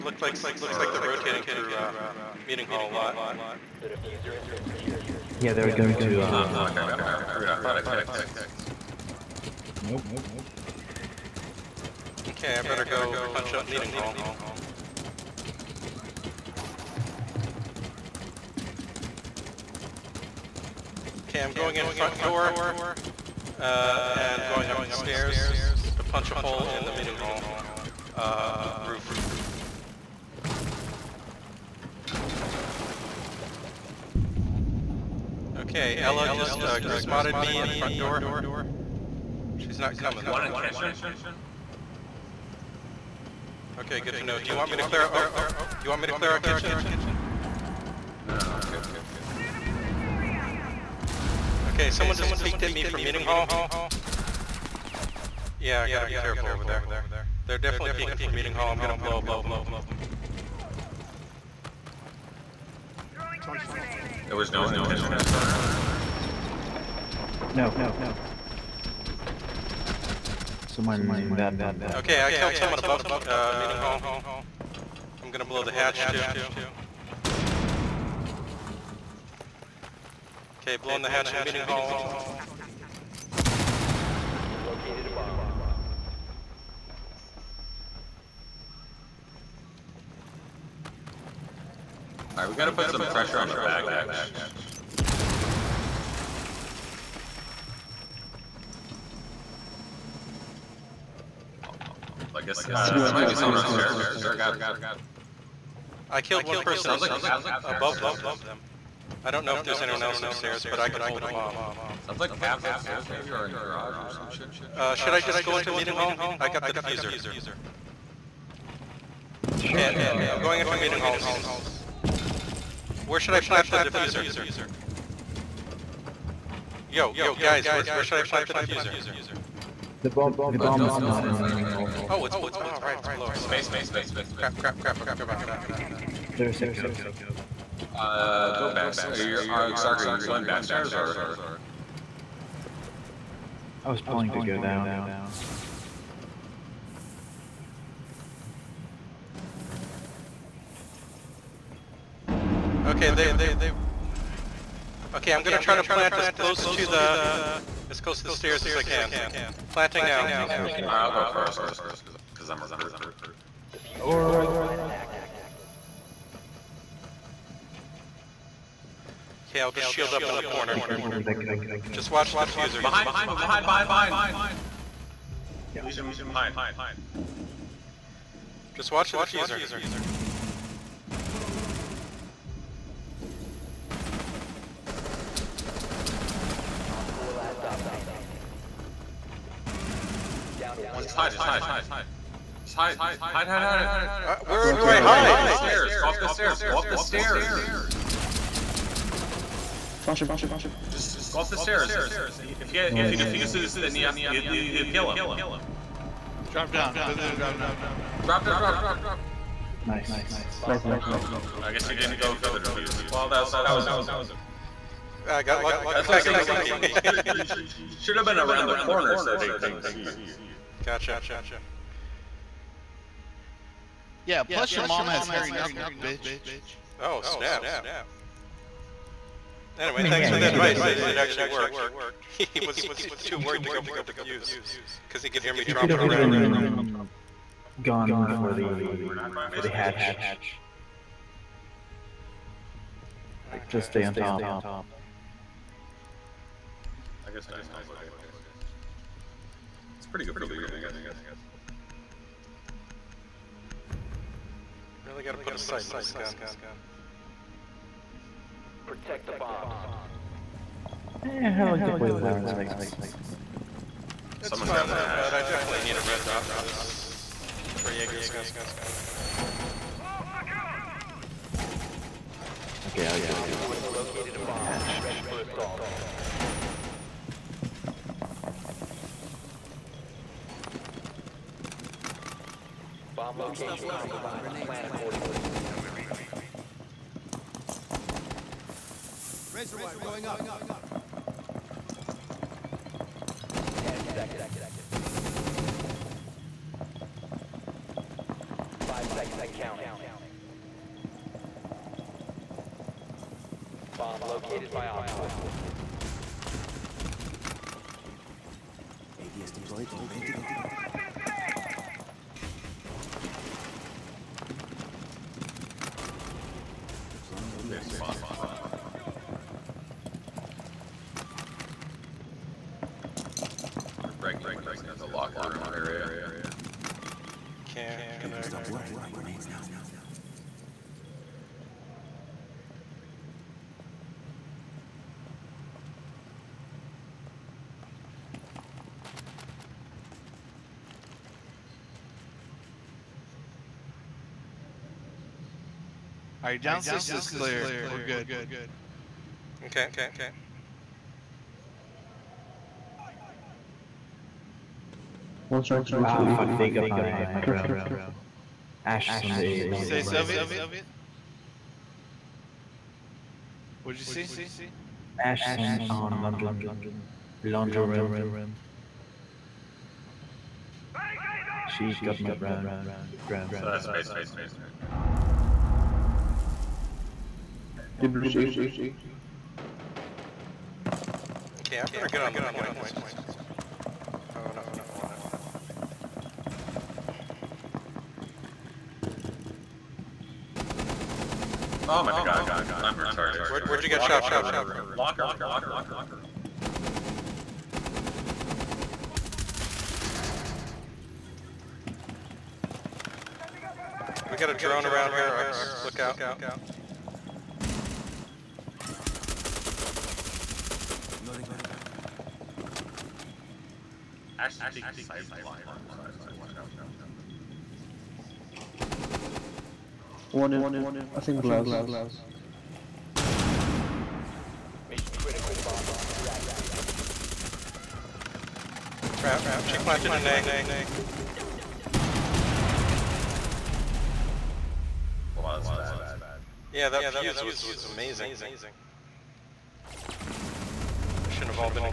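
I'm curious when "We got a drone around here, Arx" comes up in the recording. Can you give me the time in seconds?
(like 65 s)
404 s.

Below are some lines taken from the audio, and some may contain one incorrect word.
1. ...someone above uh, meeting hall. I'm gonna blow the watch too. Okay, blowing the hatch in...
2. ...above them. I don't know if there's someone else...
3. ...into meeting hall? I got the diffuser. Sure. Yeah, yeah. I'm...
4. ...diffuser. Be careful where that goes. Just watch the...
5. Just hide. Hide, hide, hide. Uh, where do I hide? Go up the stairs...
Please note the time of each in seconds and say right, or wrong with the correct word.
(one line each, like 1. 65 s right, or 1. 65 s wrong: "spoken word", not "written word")
1. 72 s wrong: "hatch", not "watch"
2. 107 s wrong: "anyone", not "someone"
3. 115 s right
4. 170 s wrong: "corner", not "diffuser"
5. 192 s right.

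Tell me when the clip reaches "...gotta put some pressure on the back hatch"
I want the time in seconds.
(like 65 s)
92 s.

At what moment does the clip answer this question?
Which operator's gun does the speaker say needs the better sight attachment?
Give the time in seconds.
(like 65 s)
267 s.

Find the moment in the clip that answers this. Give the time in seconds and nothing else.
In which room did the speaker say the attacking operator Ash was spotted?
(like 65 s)
367 s.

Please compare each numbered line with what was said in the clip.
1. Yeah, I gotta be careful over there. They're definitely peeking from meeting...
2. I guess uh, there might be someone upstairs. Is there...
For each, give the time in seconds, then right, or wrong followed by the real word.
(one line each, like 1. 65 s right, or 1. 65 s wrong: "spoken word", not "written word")
1. 55 s right
2. 102 s right.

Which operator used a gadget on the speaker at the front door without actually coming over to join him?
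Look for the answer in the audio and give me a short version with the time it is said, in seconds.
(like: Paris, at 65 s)
Ela, at 36 s.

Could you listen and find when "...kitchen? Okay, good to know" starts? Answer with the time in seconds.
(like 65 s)
40 s.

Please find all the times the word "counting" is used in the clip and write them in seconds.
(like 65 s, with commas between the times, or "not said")
299 s.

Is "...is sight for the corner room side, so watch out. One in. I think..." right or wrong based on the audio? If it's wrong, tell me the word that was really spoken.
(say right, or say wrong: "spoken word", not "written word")
wrong: "locker", not "corner".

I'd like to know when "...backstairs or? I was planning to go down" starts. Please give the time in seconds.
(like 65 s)
140 s.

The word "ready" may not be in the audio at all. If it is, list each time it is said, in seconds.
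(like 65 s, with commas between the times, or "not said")
275 s, 310 s.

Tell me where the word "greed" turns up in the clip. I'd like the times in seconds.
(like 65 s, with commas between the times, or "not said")
not said.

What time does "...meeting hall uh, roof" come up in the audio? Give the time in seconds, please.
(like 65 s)
26 s.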